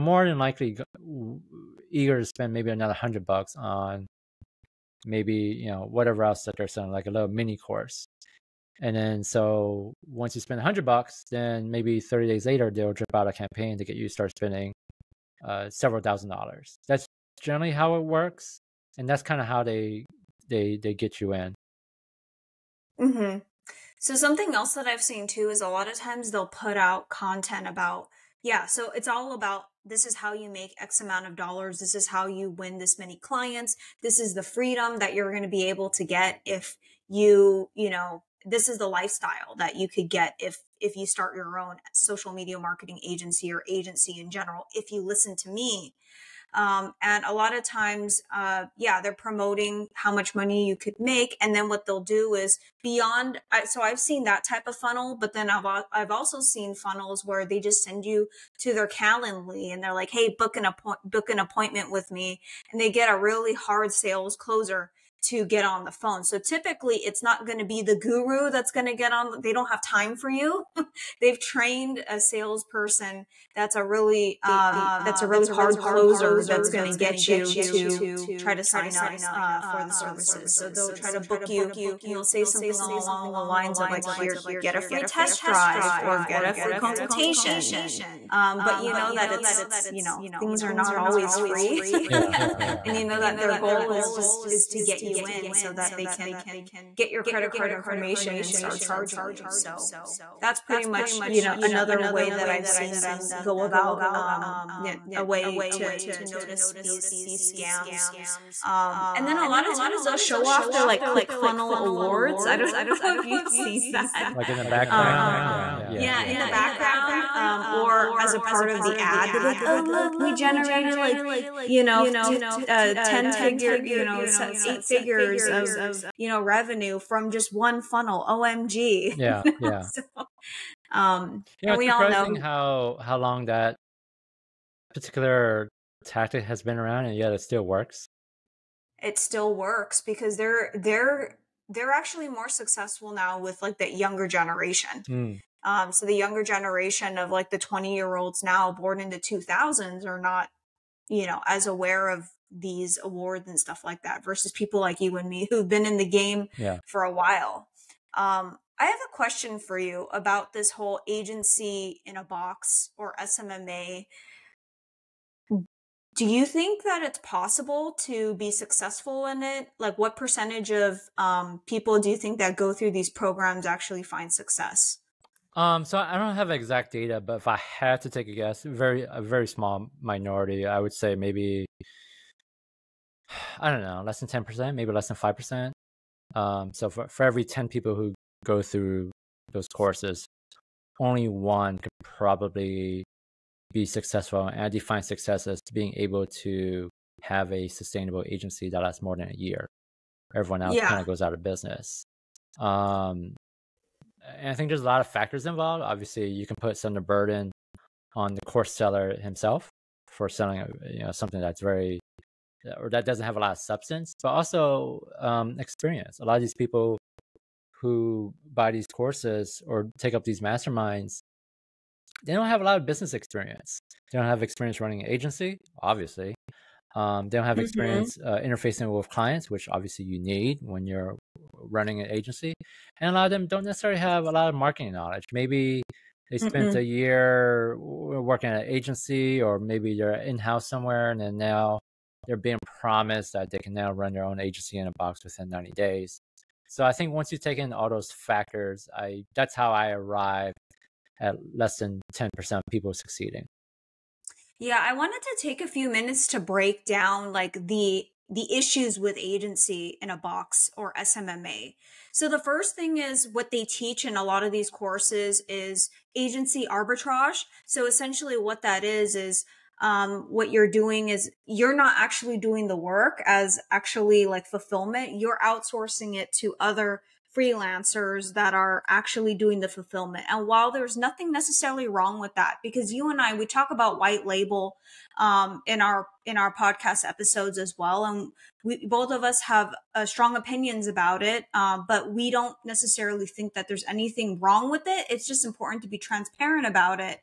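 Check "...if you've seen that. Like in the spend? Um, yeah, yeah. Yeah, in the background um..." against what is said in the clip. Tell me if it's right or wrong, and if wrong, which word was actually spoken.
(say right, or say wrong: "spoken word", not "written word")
wrong: "background", not "spend".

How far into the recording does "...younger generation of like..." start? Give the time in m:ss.
2:26.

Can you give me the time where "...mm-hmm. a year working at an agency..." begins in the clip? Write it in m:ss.
3:56.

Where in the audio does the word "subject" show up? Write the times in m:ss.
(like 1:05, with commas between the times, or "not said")
not said.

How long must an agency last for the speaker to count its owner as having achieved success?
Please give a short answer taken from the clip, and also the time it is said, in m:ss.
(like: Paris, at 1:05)
more than a year, at 3:19.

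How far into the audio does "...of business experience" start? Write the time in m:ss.
3:42.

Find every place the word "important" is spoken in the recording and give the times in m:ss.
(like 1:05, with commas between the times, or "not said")
4:55.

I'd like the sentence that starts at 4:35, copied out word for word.
You're outsourcing it to other freelancers that are actually doing the fulfillment.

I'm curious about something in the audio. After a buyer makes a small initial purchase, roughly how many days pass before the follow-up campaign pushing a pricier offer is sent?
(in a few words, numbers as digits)
30.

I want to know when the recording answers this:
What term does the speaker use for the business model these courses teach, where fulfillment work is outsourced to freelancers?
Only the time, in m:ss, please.
4:26.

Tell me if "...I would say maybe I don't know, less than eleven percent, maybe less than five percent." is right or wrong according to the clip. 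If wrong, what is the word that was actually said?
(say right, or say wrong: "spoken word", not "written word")
wrong: "ten", not "eleven".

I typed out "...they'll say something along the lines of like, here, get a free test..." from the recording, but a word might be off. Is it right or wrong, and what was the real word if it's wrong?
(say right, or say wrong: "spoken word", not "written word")
right.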